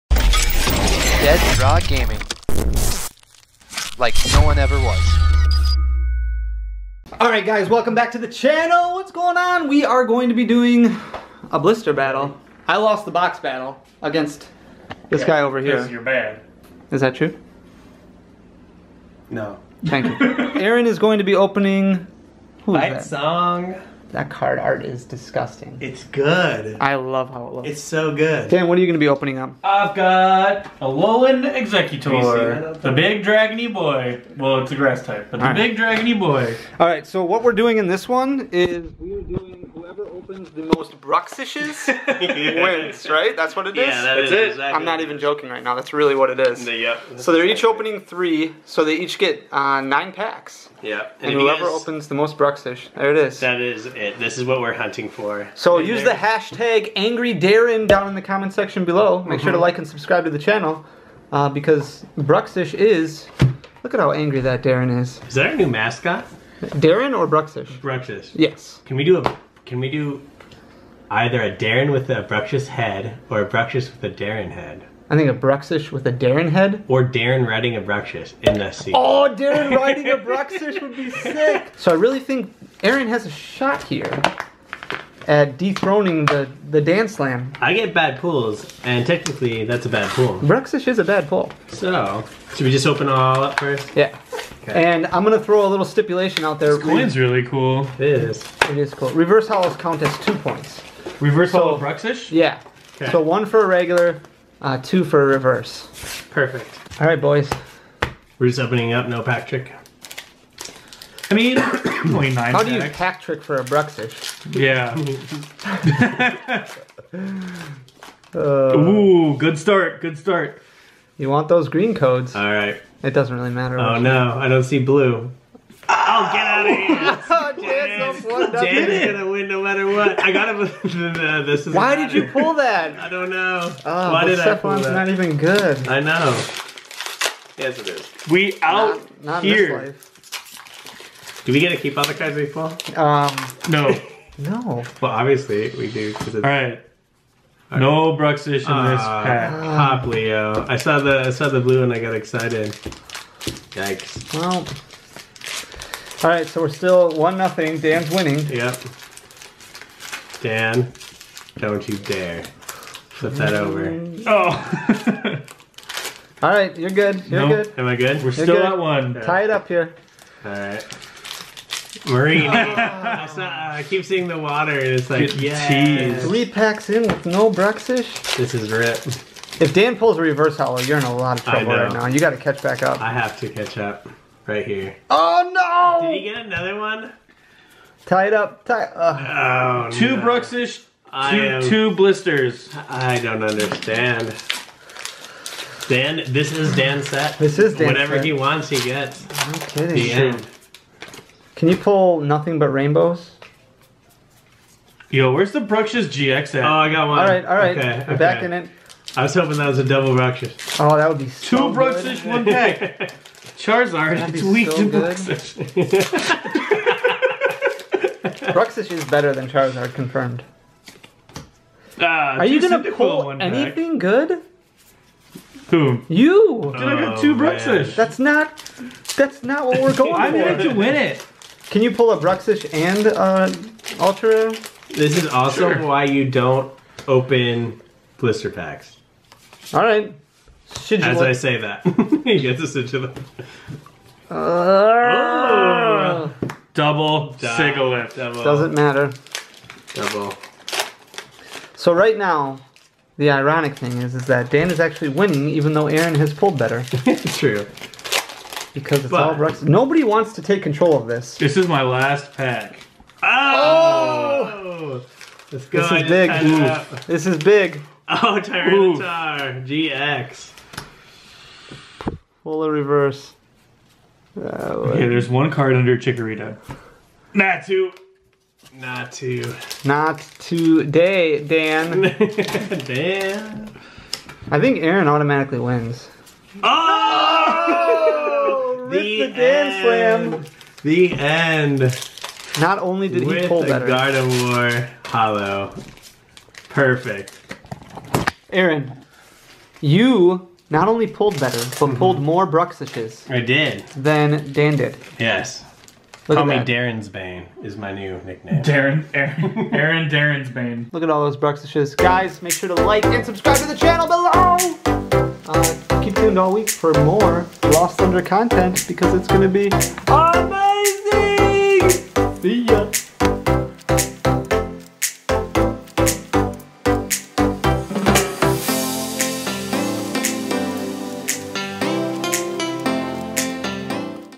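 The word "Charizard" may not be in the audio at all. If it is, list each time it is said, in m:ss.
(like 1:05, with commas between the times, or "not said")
3:33, 3:39.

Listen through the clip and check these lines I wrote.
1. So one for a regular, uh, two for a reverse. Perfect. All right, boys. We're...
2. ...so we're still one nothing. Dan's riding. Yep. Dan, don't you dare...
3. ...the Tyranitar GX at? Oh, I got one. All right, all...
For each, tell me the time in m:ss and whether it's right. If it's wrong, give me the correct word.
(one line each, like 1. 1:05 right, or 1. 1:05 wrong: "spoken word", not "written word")
1. 1:43 right
2. 2:36 wrong: "winning", not "riding"
3. 3:25 wrong: "Bruxish", not "Tyranitar".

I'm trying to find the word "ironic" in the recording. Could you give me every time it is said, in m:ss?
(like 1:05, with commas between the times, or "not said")
4:13.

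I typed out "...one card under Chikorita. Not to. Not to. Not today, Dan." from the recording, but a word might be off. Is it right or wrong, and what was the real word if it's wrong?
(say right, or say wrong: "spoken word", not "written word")
right.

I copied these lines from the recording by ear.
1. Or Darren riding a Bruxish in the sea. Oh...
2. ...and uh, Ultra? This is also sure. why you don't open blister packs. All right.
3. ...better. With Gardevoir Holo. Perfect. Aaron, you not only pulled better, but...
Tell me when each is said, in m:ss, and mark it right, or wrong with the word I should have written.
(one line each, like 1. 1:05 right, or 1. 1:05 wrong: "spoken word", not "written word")
1. 1:16 right
2. 3:52 right
3. 4:53 right.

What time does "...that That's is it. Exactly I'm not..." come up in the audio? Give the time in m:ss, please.
0:44.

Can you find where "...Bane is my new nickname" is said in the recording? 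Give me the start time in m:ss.
5:07.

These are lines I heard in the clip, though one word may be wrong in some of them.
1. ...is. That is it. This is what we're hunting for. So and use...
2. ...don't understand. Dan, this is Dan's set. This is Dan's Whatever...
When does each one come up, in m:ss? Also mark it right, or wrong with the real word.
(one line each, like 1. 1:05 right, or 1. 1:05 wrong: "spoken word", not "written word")
1. 0:53 right
2. 3:13 right.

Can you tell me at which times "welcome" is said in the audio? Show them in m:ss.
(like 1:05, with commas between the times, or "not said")
0:07.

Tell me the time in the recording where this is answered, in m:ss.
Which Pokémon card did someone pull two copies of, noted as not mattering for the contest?
4:06.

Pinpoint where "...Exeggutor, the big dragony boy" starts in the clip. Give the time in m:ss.
0:31.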